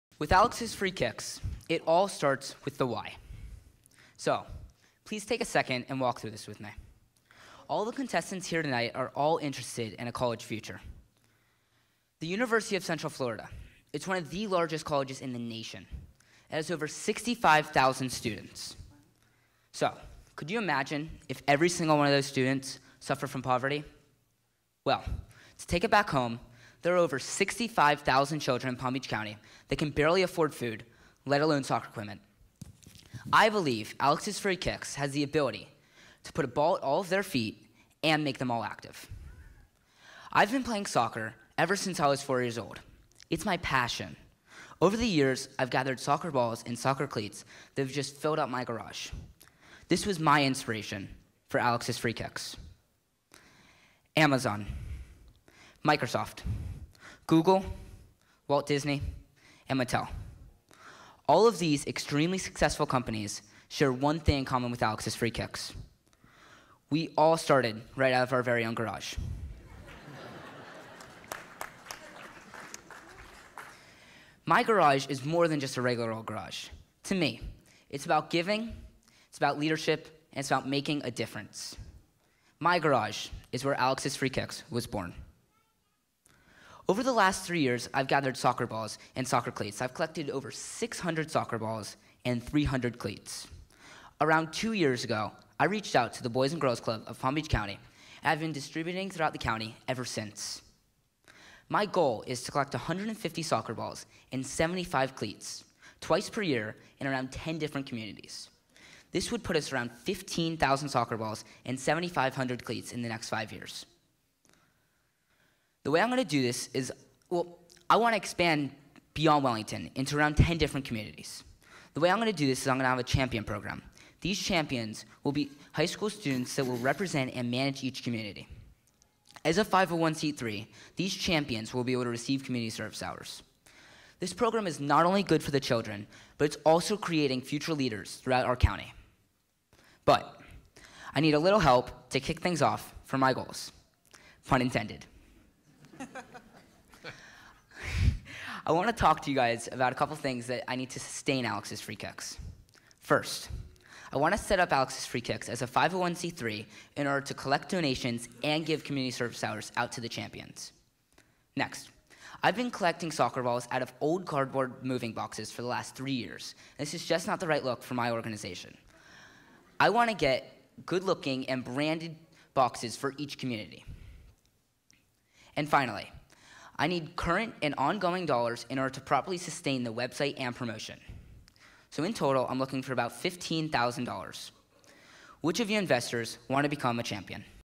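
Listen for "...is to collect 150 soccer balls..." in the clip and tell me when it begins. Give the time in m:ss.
1:42.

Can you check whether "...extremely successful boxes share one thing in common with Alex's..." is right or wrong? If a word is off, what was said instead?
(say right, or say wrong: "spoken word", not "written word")
wrong: "companies", not "boxes".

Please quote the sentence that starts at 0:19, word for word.
So, could you imagine if every single one of those students suffered from poverty?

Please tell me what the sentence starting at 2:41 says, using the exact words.
Next, I've been collecting soccer balls out of old cardboard moving boxes for the last three years.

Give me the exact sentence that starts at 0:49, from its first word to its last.
This was my inspiration for Alex's free kicks.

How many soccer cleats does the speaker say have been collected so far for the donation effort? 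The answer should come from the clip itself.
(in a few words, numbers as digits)
300.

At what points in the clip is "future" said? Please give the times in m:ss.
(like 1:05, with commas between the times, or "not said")
0:10, 2:17.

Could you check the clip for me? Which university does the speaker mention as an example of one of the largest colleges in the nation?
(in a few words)
University of Central Florida.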